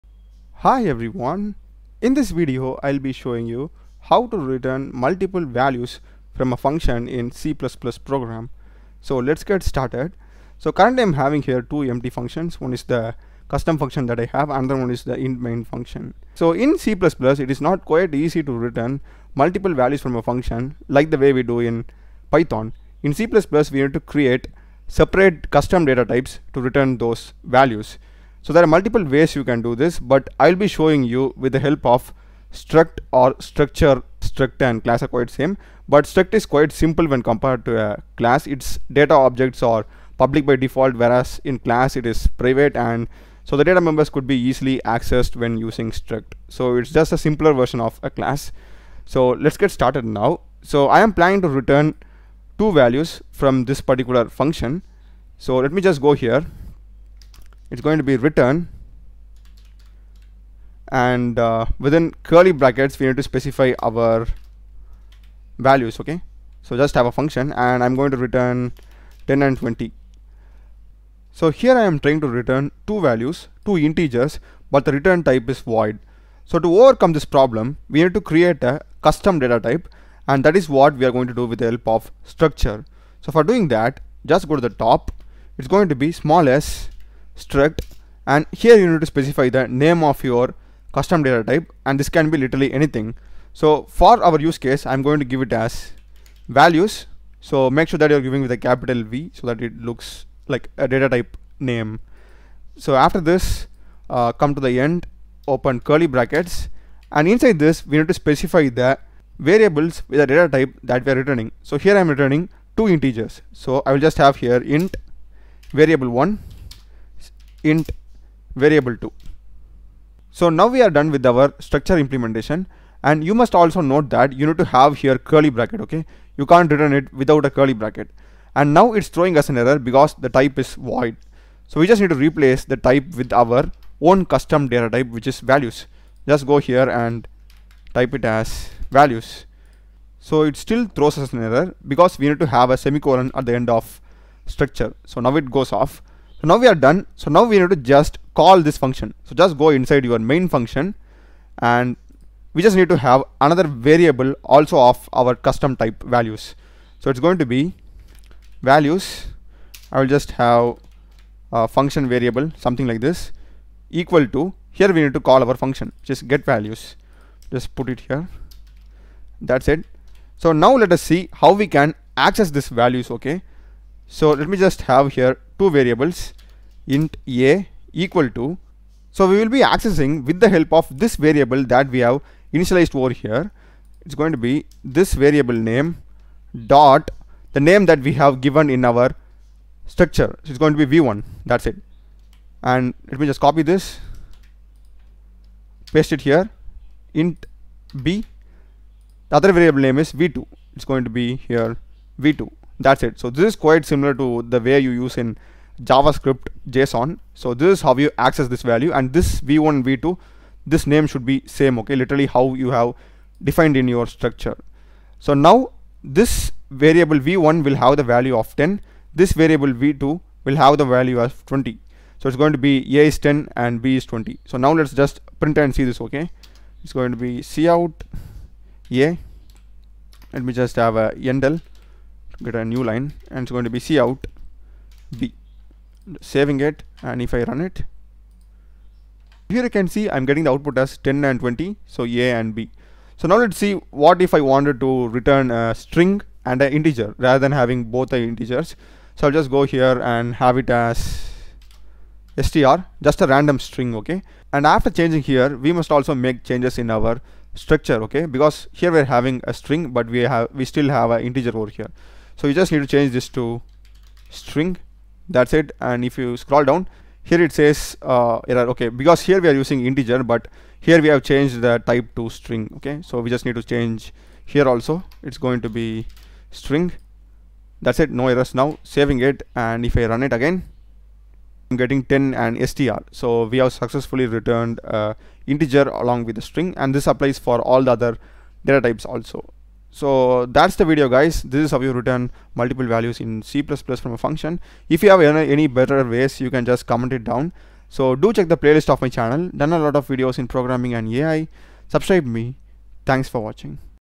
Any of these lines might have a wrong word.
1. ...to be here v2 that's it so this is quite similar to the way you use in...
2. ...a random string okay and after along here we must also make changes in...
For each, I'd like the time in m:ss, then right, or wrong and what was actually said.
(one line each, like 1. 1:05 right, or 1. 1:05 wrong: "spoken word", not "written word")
1. 3:21 right
2. 4:13 wrong: "changing", not "along".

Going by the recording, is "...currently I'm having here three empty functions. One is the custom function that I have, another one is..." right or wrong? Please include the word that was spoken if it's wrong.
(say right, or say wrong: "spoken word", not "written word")
wrong: "two", not "three".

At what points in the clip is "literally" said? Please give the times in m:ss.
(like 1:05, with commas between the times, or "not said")
1:32, 3:31.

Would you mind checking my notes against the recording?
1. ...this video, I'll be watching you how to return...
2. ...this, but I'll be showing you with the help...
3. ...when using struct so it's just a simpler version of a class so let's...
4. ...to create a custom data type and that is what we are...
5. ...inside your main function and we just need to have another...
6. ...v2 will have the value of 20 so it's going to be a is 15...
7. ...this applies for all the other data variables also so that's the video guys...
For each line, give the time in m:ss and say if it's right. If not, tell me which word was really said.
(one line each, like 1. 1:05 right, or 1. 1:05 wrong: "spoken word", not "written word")
1. 0:02 wrong: "showing", not "watching"
2. 0:29 right
3. 0:45 right
4. 1:18 right
5. 2:29 right
6. 3:39 wrong: "10", not "15"
7. 4:46 wrong: "types", not "variables".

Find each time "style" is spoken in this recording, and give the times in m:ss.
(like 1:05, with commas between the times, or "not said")
not said.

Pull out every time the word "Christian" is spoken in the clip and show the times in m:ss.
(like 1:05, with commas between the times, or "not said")
not said.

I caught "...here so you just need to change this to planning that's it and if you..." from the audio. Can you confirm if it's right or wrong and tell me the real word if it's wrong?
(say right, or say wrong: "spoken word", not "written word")
wrong: "string", not "planning".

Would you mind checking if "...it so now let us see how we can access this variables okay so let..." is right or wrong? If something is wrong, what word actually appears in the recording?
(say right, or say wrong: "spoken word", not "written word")
wrong: "values", not "variables".